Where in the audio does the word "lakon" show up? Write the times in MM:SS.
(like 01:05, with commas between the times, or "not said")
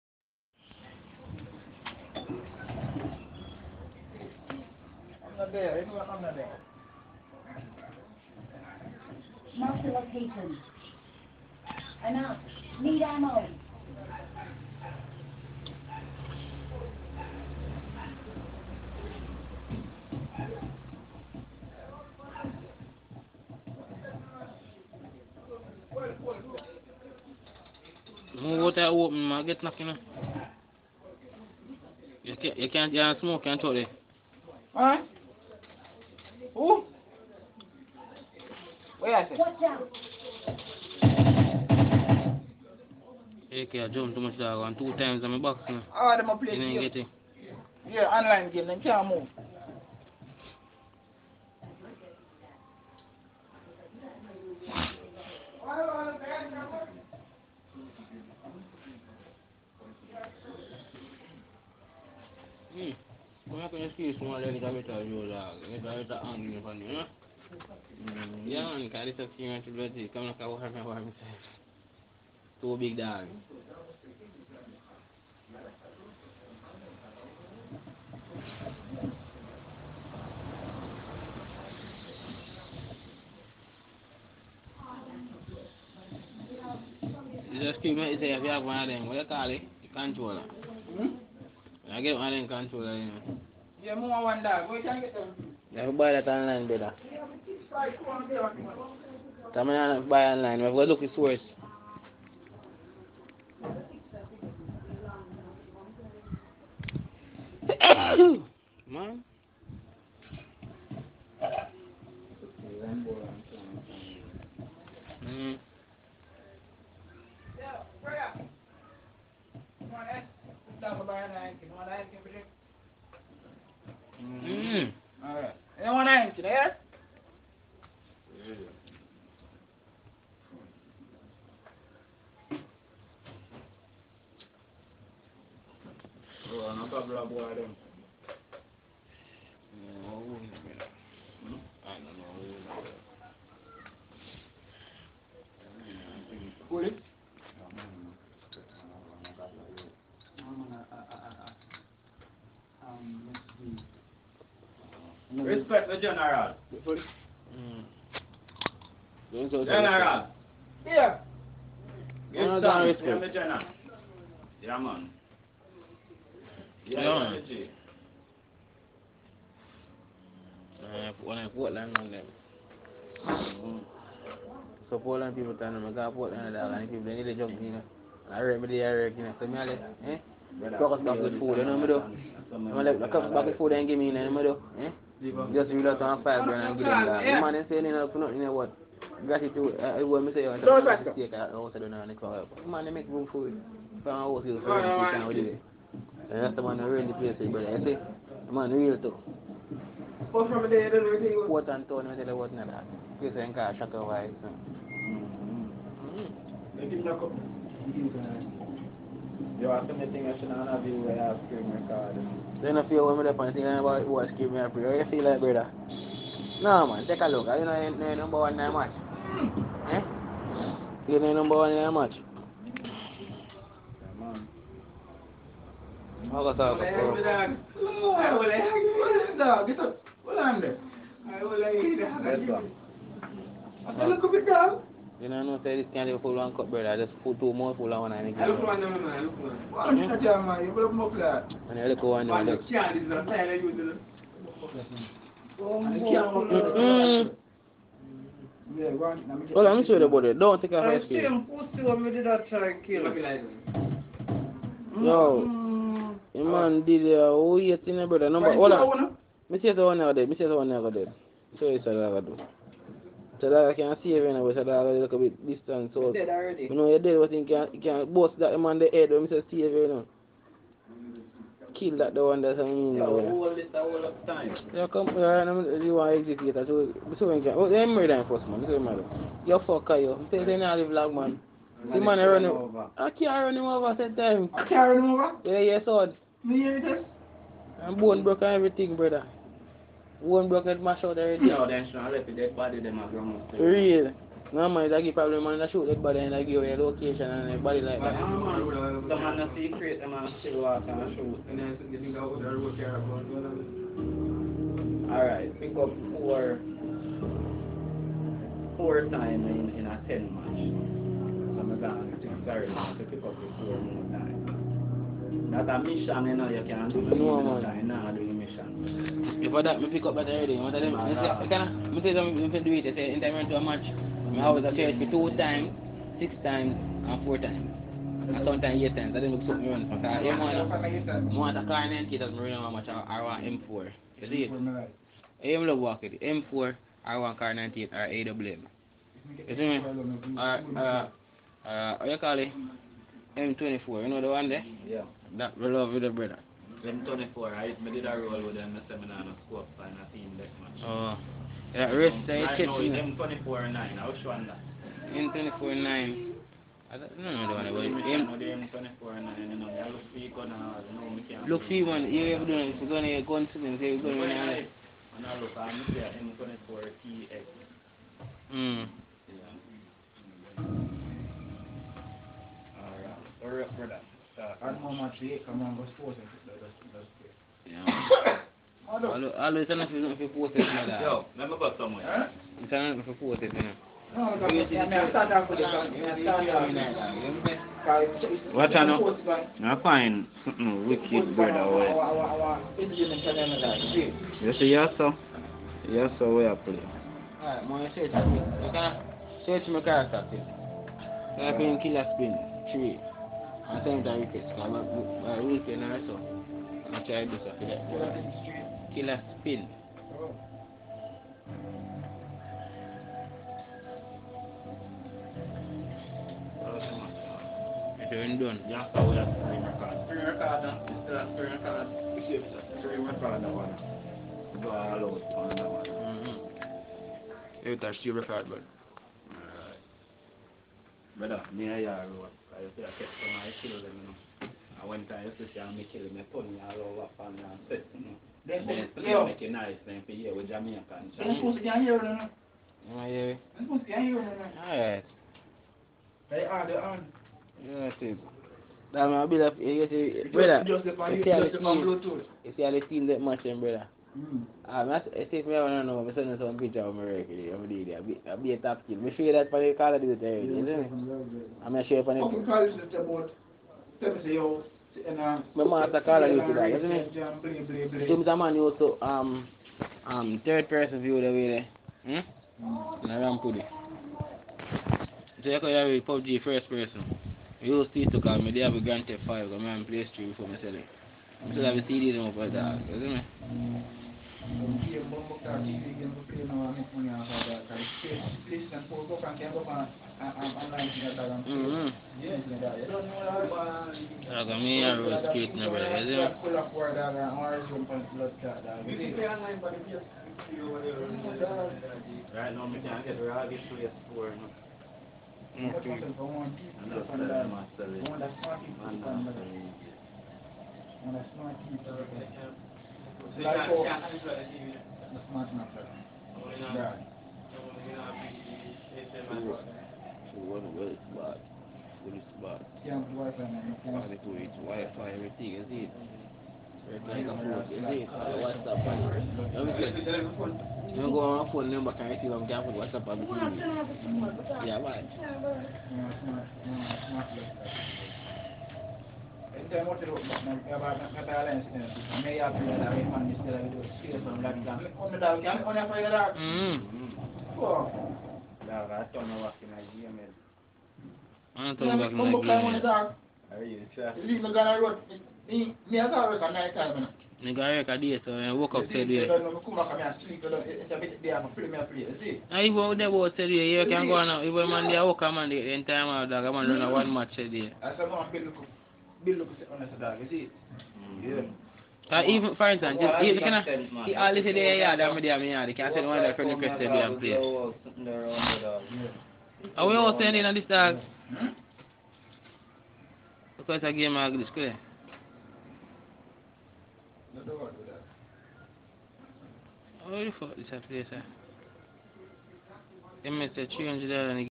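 04:25.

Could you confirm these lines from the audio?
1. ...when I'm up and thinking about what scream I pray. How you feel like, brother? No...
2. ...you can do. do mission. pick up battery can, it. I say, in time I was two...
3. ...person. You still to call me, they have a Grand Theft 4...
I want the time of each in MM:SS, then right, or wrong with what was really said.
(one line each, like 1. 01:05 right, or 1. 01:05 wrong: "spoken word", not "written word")
1. 03:33 right
2. 05:16 right
3. 07:56 wrong: "5", not "4".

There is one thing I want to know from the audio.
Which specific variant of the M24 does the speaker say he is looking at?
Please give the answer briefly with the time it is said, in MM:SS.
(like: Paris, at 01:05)
M24 TX, at 06:06.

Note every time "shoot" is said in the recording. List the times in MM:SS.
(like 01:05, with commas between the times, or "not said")
04:55, 05:01.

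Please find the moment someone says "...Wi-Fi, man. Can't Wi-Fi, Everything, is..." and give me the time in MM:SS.
08:43.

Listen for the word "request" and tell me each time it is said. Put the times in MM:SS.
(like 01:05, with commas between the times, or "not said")
09:36.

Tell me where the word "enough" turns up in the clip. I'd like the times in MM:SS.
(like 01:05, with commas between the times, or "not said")
03:07.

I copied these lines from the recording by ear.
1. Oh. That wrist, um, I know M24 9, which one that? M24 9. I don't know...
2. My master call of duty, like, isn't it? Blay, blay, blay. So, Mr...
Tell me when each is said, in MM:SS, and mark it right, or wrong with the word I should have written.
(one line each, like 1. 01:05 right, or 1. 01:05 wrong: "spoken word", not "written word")
1. 05:50 right
2. 07:45 right.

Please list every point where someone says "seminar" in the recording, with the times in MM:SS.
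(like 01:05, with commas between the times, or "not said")
05:48.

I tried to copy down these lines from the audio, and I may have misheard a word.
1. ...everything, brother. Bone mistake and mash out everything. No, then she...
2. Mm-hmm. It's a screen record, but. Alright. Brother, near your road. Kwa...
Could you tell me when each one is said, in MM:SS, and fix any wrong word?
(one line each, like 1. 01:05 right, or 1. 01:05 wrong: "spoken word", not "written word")
1. 04:48 wrong: "broke", not "mistake"
2. 07:05 right.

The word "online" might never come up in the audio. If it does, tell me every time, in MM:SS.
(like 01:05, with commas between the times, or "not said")
00:48, 01:40.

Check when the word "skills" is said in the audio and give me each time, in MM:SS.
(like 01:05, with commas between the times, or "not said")
01:03.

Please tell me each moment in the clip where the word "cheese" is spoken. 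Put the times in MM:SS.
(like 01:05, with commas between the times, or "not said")
not said.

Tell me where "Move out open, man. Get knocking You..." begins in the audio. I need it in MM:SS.
00:28.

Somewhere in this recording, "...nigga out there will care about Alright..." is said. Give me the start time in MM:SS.
05:01.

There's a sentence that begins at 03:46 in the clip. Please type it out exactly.
I will like hit I You know, no say this can't full one cup, brother.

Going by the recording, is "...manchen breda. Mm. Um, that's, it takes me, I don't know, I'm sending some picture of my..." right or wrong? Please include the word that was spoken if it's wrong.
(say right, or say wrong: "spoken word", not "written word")
right.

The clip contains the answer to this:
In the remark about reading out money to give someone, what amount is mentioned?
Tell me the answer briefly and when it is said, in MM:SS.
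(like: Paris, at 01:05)
5 grand, at 03:06.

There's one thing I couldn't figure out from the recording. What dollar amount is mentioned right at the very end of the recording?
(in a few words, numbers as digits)
300 dollars.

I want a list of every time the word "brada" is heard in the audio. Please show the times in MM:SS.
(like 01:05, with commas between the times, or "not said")
04:18.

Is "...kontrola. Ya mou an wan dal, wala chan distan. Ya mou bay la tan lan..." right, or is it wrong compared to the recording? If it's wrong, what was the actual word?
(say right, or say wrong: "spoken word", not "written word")
wrong: "getan", not "distan".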